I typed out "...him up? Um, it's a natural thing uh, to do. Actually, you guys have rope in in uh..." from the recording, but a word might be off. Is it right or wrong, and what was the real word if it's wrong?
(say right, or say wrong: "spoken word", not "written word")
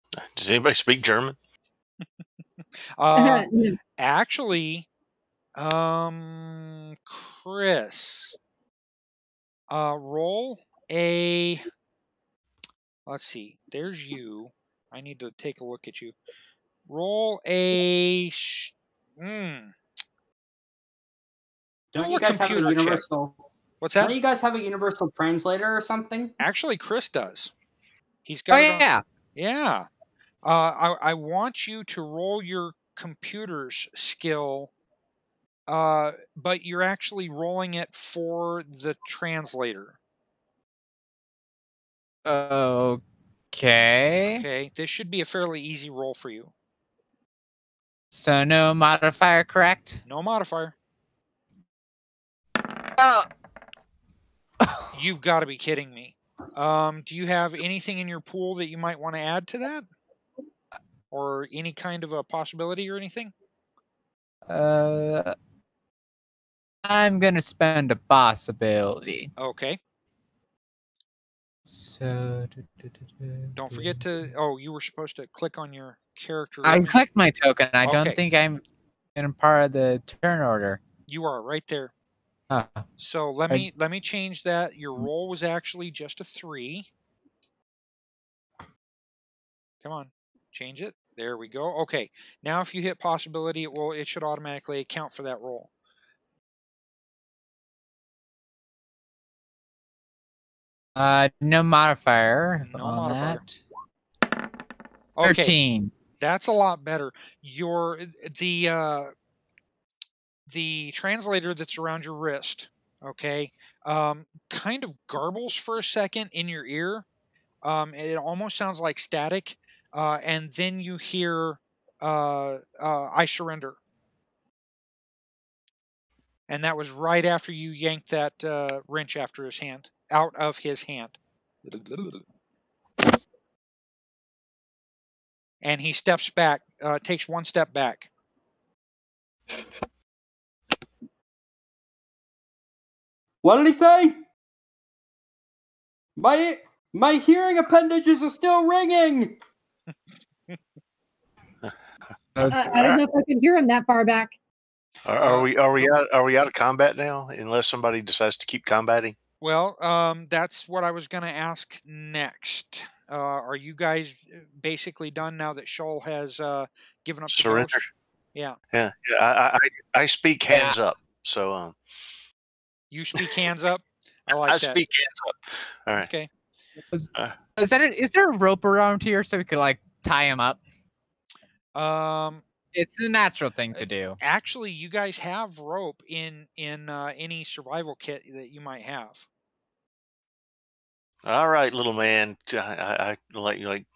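right.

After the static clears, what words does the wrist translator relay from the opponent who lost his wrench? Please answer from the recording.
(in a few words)
I surrender.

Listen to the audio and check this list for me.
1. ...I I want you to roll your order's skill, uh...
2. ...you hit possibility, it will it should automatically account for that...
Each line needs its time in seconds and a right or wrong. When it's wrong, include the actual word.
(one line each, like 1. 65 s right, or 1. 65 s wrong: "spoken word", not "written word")
1. 30 s wrong: "computer", not "order"
2. 92 s right.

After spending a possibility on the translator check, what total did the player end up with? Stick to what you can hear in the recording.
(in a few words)
13.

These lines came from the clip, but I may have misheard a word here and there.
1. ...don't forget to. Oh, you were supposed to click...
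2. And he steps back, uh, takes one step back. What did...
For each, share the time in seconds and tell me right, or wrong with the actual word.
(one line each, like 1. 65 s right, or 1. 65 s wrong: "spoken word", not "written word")
1. 73 s right
2. 135 s right.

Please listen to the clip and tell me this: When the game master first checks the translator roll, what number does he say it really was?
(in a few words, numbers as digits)
3.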